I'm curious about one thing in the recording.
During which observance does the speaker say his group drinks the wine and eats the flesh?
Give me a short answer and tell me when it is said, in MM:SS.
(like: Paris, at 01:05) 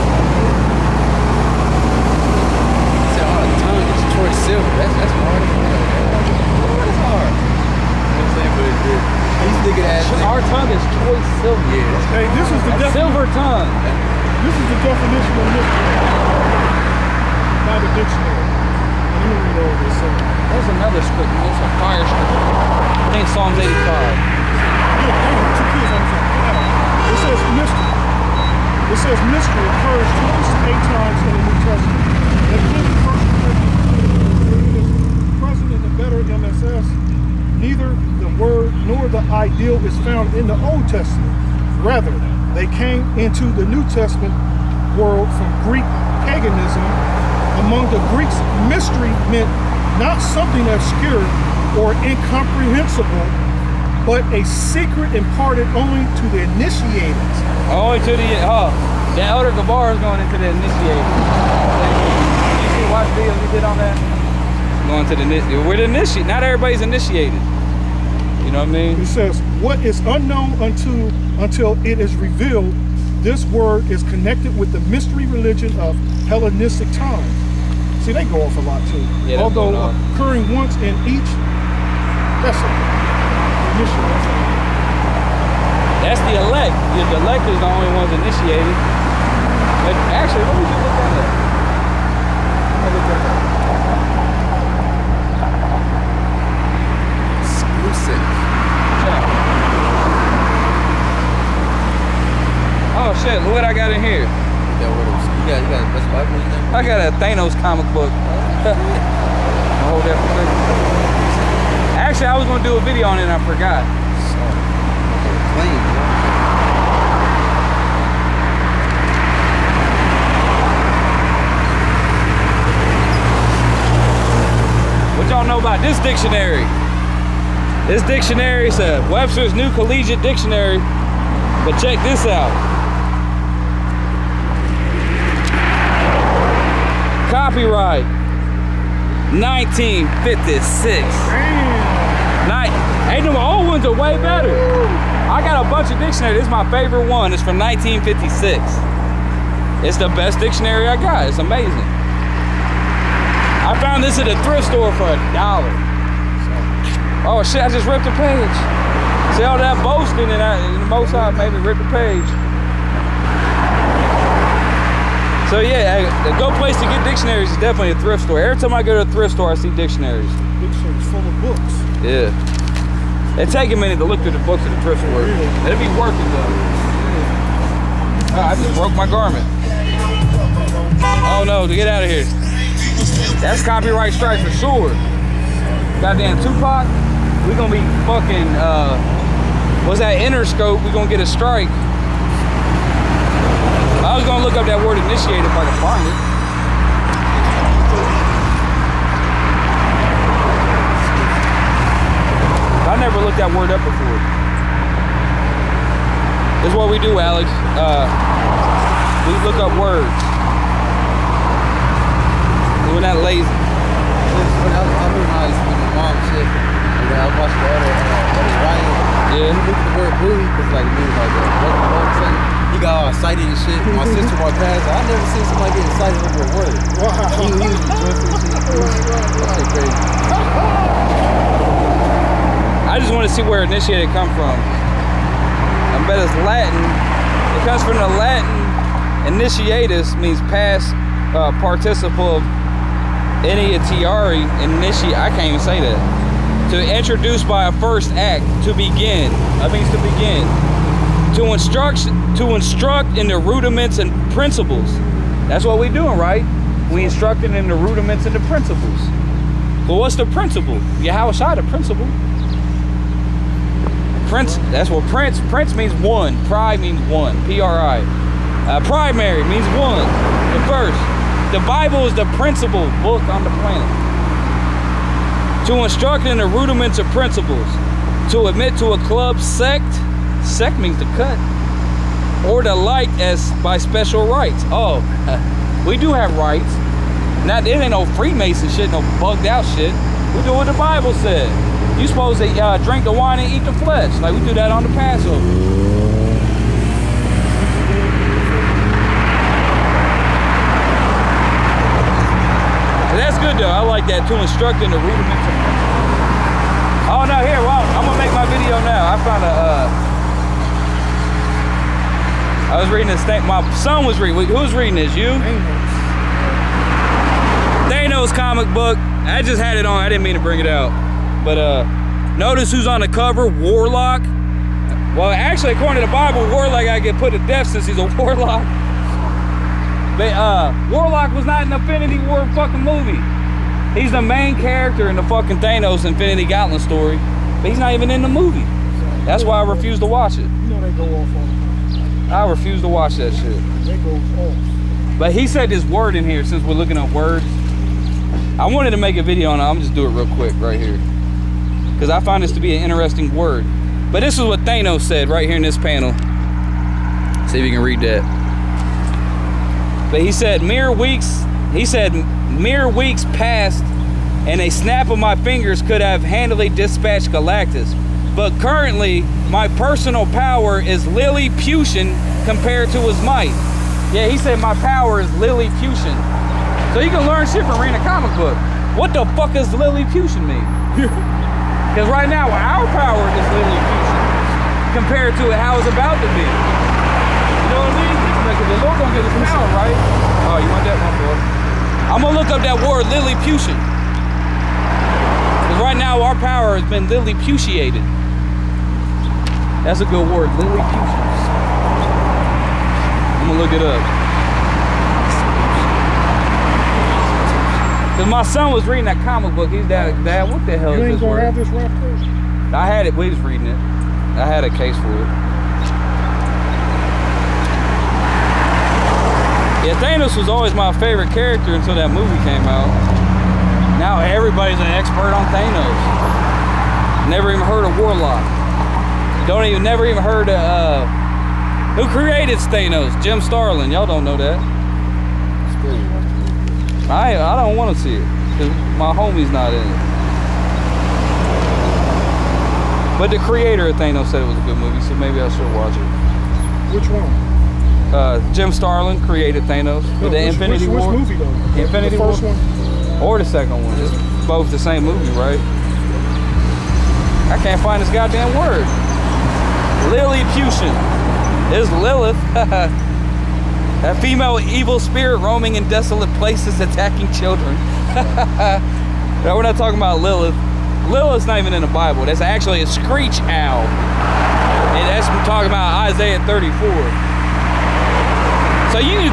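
Passover, at 04:54.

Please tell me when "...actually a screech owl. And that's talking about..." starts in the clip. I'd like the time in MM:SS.
07:52.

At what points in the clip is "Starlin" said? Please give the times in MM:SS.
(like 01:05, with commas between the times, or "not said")
07:13, 07:28.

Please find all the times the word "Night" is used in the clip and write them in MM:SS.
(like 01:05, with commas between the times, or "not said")
02:22.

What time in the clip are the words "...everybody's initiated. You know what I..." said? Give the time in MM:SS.
01:06.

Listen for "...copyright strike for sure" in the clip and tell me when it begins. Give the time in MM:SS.
03:03.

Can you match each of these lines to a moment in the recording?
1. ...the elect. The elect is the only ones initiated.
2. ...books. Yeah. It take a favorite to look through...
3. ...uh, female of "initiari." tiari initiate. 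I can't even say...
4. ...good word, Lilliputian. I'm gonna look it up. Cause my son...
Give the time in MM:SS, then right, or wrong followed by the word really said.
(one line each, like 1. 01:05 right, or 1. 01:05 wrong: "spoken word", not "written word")
1. 01:26 right
2. 02:51 wrong: "minute", not "favorite"
3. 04:01 wrong: "participle", not "female"
4. 06:40 right.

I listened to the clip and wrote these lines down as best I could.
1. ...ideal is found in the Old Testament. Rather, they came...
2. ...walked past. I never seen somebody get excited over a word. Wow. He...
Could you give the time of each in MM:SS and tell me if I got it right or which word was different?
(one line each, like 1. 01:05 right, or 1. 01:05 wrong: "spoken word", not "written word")
1. 00:39 right
2. 03:44 right.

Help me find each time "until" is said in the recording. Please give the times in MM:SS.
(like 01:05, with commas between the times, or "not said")
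01:11, 07:01.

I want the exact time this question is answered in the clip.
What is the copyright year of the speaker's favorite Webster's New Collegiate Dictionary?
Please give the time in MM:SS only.
02:17.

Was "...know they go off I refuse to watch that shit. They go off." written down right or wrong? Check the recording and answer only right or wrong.
right.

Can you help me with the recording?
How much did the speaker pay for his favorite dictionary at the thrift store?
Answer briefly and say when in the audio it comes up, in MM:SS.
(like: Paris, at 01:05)
a dollar, at 02:35.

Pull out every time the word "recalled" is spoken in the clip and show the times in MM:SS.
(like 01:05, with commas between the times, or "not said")
not said.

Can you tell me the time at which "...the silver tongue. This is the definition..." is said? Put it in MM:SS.
00:12.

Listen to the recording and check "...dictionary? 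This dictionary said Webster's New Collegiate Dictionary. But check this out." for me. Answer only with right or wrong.
right.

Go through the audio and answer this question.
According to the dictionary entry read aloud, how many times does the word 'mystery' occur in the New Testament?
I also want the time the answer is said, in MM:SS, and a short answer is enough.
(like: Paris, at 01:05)
28, at 00:30.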